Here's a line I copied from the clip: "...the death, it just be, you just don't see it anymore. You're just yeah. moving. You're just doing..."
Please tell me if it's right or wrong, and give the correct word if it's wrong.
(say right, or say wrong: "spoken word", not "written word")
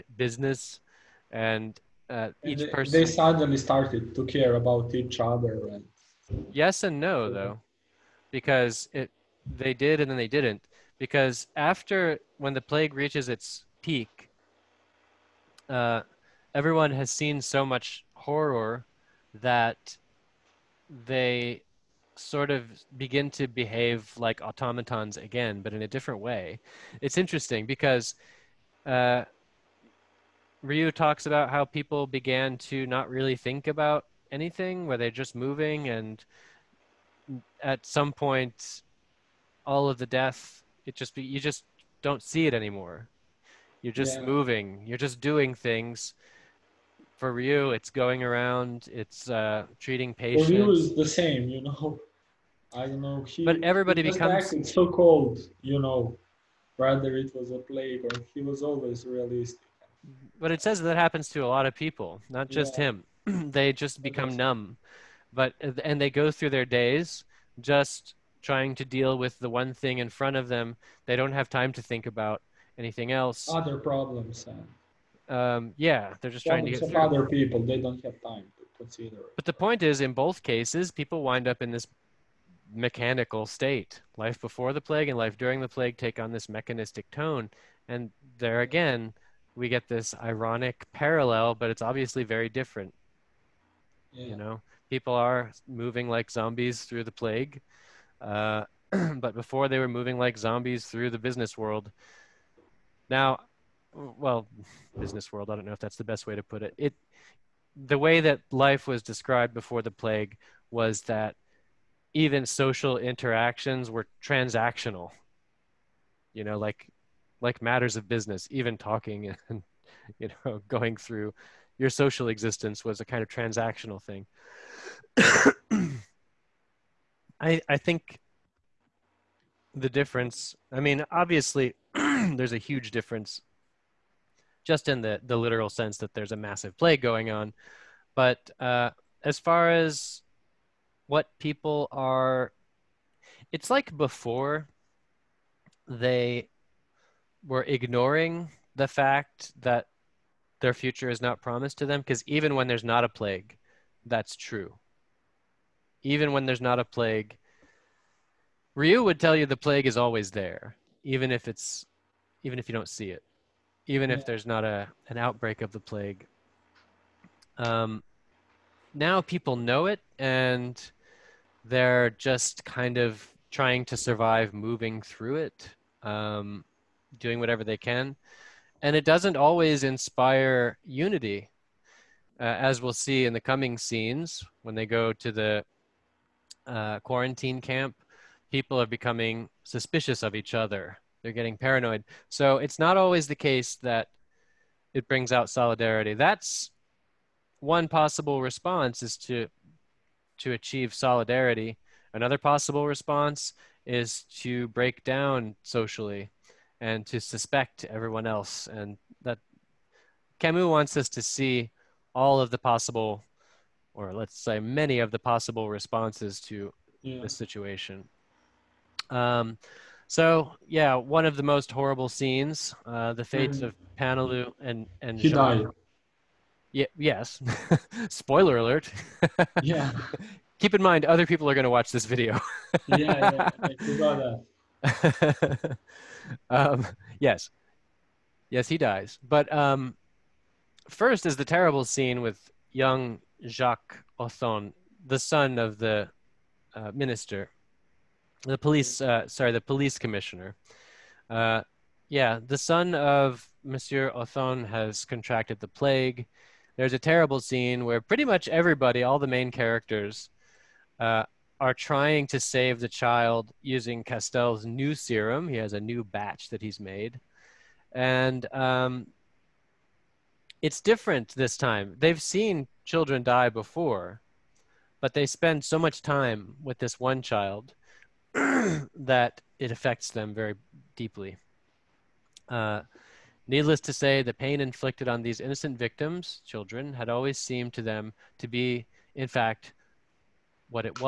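right.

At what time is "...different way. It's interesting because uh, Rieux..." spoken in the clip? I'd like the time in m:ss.
0:25.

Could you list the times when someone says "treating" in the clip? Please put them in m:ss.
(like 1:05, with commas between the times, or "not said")
0:49.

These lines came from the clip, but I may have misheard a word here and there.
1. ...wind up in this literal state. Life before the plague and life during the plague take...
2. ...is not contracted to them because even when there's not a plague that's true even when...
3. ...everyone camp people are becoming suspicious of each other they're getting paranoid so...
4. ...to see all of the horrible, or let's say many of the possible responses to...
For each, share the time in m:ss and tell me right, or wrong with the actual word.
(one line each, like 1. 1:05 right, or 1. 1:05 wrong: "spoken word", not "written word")
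1. 1:21 wrong: "mechanical", not "literal"
2. 2:31 wrong: "promised", not "contracted"
3. 3:06 wrong: "quarantine", not "everyone"
4. 3:31 wrong: "possible", not "horrible".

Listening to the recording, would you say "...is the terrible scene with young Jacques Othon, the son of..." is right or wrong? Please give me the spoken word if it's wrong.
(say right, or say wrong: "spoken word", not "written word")
right.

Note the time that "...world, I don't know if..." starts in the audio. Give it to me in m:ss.
1:45.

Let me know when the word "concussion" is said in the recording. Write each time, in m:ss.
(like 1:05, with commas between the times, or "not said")
not said.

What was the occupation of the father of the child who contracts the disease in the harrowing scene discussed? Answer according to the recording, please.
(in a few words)
police commissioner.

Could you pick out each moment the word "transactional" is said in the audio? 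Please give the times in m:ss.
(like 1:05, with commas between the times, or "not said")
1:54, 2:03.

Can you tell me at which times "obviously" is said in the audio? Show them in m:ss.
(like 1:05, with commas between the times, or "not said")
1:31, 2:11.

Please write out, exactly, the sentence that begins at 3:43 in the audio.
of Paneloux and and she Jean.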